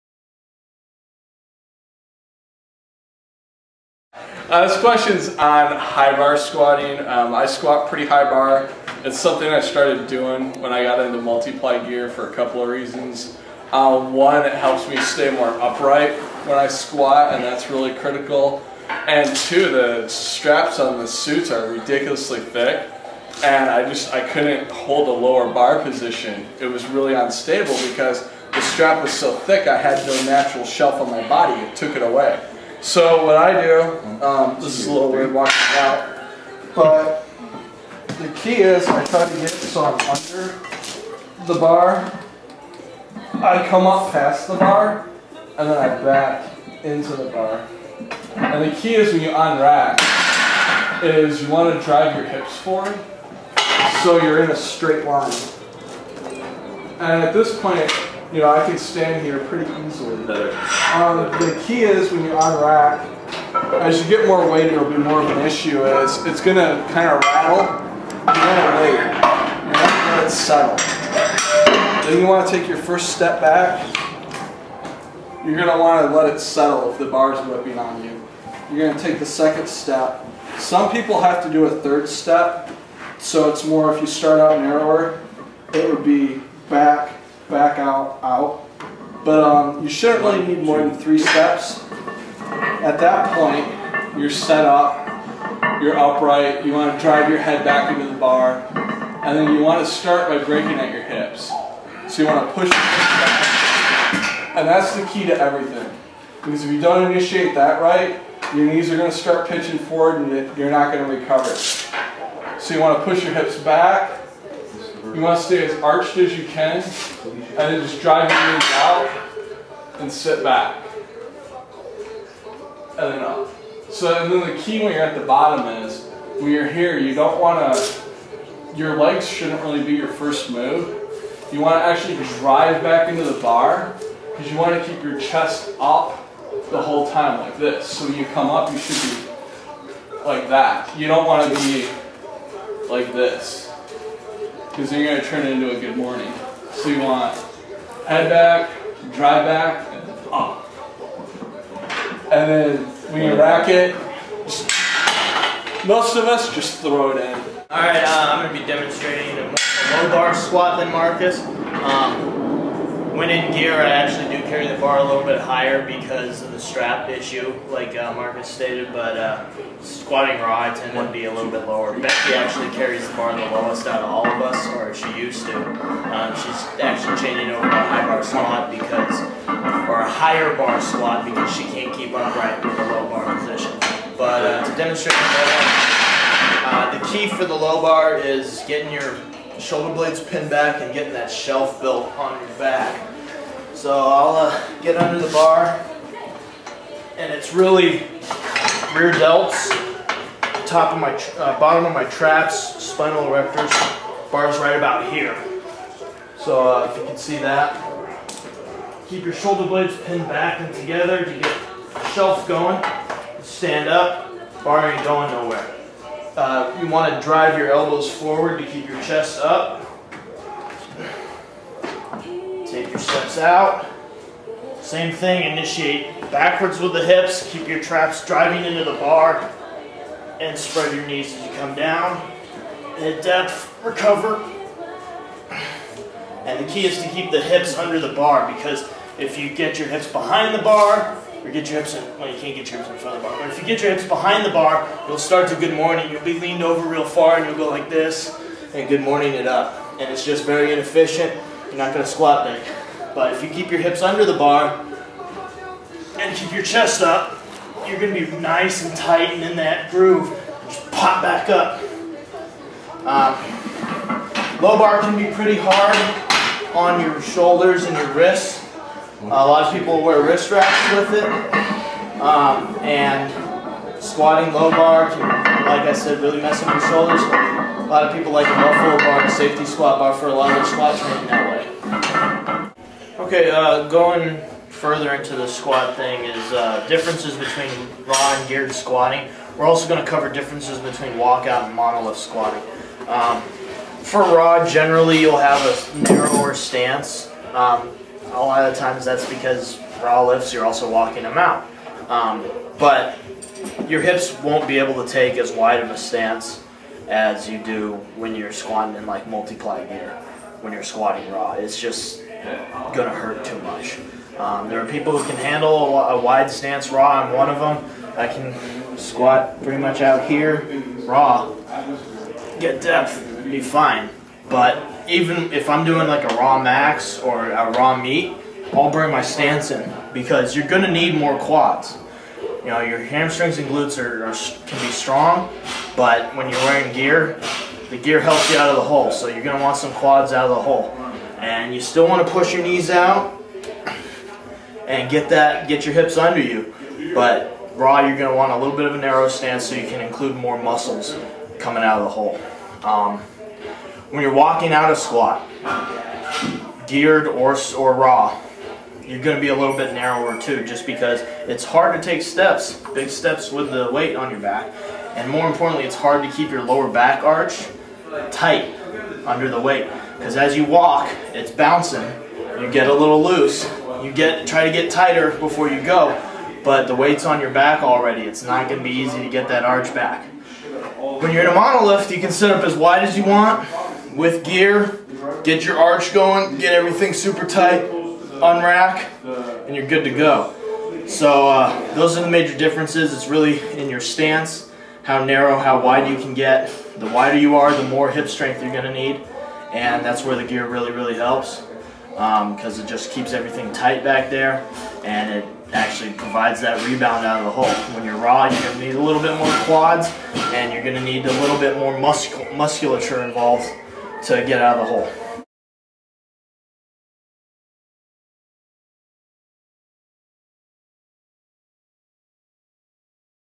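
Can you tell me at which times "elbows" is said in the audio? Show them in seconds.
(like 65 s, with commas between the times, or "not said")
217 s.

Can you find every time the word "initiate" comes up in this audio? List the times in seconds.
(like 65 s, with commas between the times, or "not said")
107 s, 225 s.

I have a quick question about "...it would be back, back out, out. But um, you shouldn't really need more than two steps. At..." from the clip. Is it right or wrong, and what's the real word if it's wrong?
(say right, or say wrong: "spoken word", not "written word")
wrong: "three", not "two".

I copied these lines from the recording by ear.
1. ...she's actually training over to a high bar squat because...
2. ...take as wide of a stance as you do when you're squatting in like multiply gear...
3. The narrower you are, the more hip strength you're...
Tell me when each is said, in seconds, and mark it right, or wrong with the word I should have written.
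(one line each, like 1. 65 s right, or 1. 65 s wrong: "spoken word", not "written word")
1. 176 s wrong: "changing", not "training"
2. 305 s right
3. 396 s wrong: "wider", not "narrower".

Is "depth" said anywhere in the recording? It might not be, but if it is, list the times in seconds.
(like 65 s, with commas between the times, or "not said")
233 s, 322 s.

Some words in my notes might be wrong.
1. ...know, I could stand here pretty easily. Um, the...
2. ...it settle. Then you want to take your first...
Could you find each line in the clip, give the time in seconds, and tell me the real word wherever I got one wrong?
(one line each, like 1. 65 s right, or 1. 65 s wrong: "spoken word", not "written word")
1. 58 s right
2. 70 s right.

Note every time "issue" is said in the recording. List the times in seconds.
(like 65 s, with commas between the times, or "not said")
65 s, 167 s.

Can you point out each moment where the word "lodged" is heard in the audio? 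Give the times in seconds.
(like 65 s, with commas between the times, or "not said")
not said.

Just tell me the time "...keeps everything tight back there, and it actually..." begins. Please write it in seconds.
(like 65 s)
403 s.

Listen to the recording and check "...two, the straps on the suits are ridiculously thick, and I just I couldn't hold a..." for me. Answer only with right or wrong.
right.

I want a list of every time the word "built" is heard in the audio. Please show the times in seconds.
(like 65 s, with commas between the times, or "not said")
191 s.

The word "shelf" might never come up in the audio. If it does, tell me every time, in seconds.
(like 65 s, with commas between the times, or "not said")
30 s, 191 s, 212 s.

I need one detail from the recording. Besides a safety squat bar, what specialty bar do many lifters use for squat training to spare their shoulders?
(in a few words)
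Buffalo bar.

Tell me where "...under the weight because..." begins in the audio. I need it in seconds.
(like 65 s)
369 s.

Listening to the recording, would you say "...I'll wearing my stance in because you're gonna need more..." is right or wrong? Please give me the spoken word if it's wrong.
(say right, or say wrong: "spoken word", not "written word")
wrong: "bring", not "wearing".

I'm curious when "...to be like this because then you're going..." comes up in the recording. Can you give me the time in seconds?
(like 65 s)
141 s.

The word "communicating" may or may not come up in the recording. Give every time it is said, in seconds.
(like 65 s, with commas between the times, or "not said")
not said.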